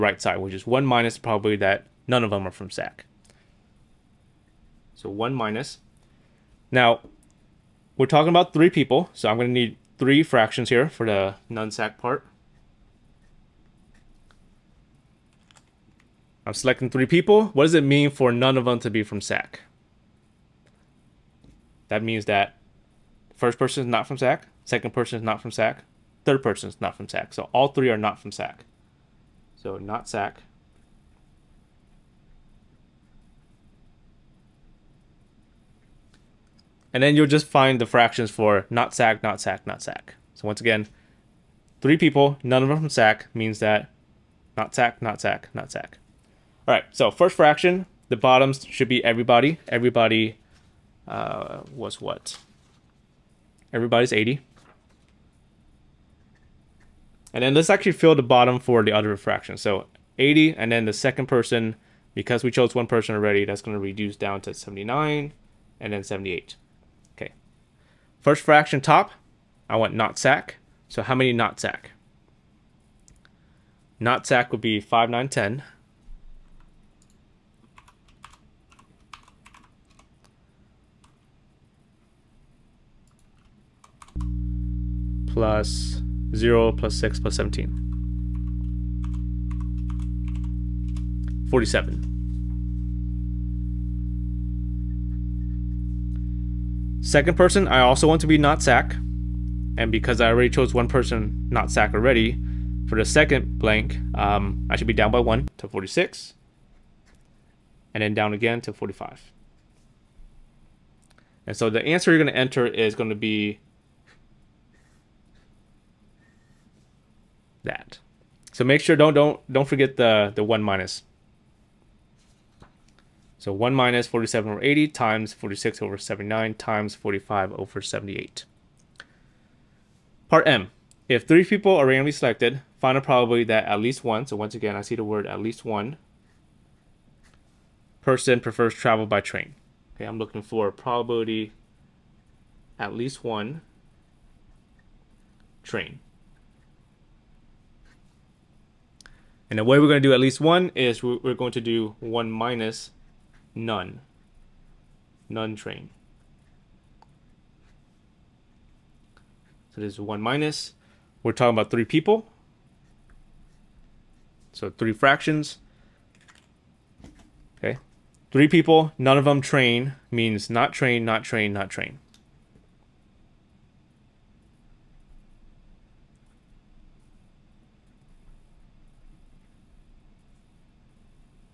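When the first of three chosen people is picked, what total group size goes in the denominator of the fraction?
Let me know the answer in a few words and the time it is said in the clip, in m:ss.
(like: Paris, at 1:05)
80, at 0:53.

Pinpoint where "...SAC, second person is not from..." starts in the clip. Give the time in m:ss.
0:24.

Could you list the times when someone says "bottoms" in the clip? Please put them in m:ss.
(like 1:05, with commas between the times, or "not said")
0:48, 0:58.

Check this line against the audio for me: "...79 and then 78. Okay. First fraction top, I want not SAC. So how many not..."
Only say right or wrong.
right.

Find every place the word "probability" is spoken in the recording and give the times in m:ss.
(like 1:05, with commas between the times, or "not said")
0:01, 2:13, 2:20.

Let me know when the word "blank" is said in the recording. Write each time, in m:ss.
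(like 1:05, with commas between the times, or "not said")
1:43.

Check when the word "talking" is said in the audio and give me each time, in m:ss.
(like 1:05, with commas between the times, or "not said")
0:08, 2:41.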